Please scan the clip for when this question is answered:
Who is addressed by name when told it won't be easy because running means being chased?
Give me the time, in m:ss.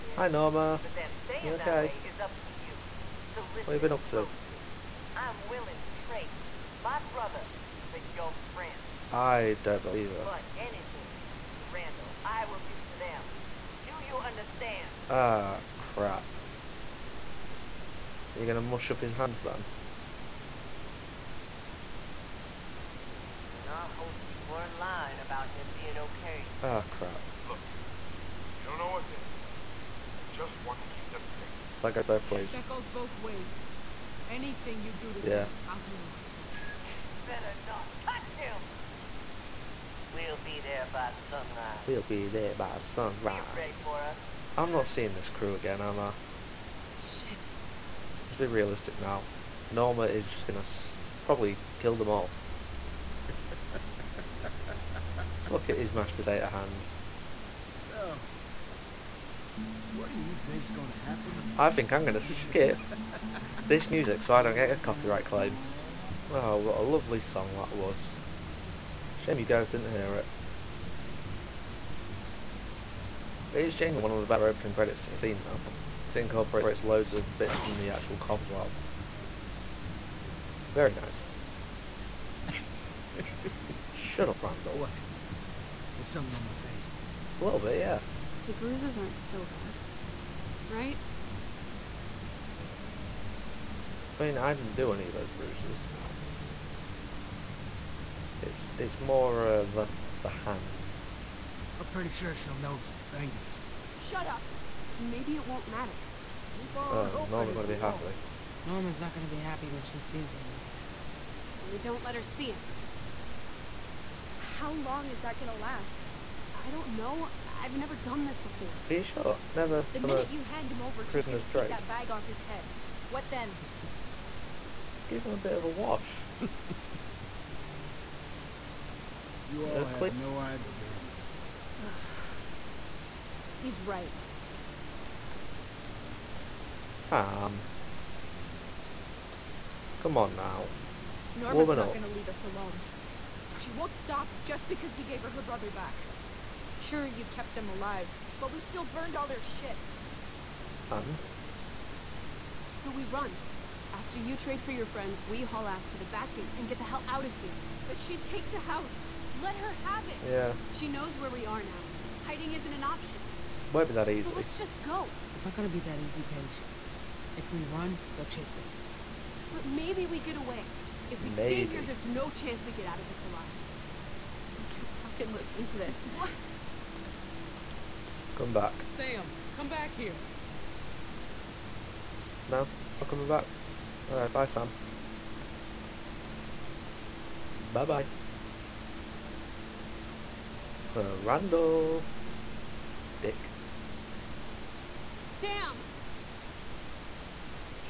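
2:46.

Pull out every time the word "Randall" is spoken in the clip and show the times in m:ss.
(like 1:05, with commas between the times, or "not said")
0:11, 0:36, 1:24, 3:11.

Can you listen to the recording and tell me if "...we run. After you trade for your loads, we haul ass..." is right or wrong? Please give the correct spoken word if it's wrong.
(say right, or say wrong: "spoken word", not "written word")
wrong: "friends", not "loads".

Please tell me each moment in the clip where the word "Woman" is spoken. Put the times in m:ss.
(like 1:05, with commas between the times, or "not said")
2:21.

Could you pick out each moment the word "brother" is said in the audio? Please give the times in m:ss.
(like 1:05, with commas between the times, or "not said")
0:07, 2:25.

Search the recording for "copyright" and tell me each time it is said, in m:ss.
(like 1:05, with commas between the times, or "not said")
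1:04.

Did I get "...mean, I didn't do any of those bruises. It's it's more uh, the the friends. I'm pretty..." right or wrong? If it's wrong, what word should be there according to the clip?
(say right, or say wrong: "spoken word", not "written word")
wrong: "hands", not "friends".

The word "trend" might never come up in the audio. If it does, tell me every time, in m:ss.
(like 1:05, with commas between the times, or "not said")
not said.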